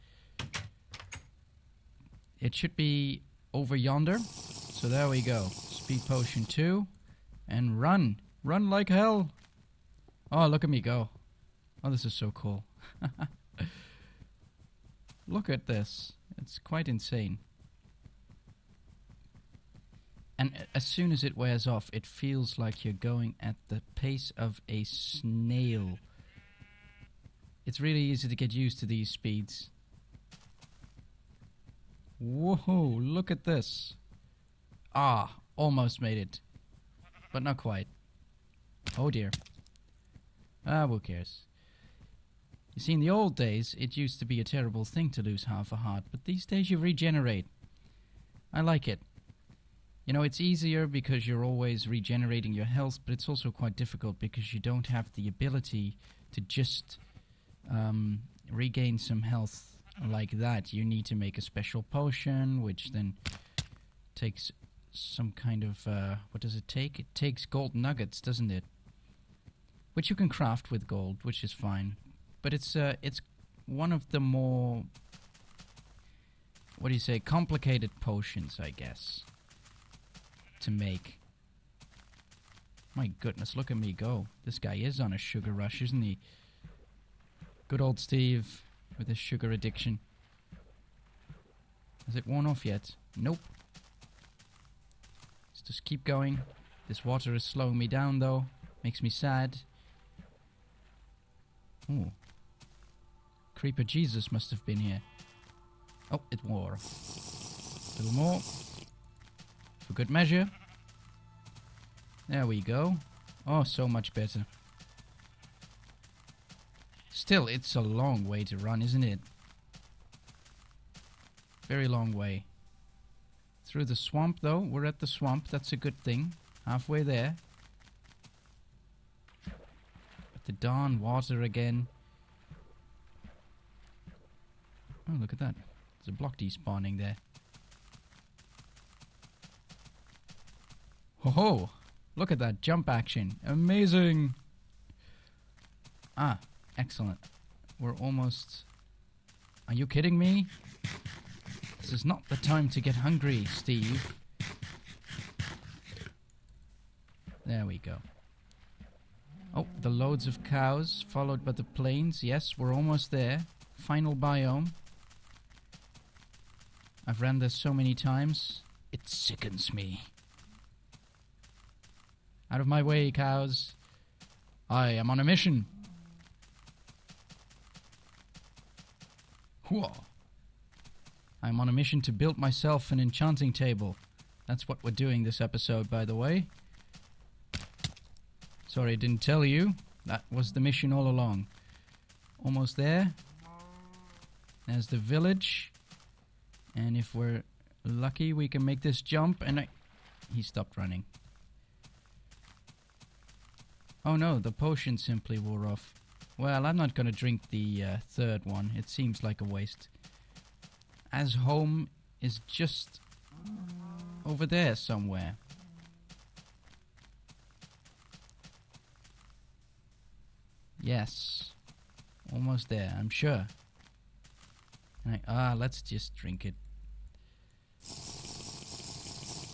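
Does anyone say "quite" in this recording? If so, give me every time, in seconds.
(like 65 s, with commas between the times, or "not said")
16 s, 37 s, 53 s.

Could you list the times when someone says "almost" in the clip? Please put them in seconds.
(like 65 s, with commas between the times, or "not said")
35 s, 147 s, 162 s, 192 s, 222 s.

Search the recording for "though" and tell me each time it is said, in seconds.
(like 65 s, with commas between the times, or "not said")
98 s, 124 s.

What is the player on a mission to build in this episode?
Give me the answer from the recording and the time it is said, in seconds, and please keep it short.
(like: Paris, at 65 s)
An enchanting table, at 182 s.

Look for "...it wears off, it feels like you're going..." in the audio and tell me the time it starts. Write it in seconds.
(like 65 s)
21 s.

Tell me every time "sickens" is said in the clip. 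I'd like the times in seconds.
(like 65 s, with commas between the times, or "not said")
169 s.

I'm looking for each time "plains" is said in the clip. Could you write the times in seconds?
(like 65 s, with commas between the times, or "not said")
161 s.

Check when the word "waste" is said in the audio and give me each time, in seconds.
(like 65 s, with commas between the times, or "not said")
209 s.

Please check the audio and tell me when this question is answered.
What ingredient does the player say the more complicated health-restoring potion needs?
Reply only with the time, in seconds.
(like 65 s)
67 s.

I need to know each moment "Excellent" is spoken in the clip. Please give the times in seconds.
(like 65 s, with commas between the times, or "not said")
146 s.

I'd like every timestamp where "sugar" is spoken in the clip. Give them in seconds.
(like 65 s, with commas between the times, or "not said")
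85 s, 89 s.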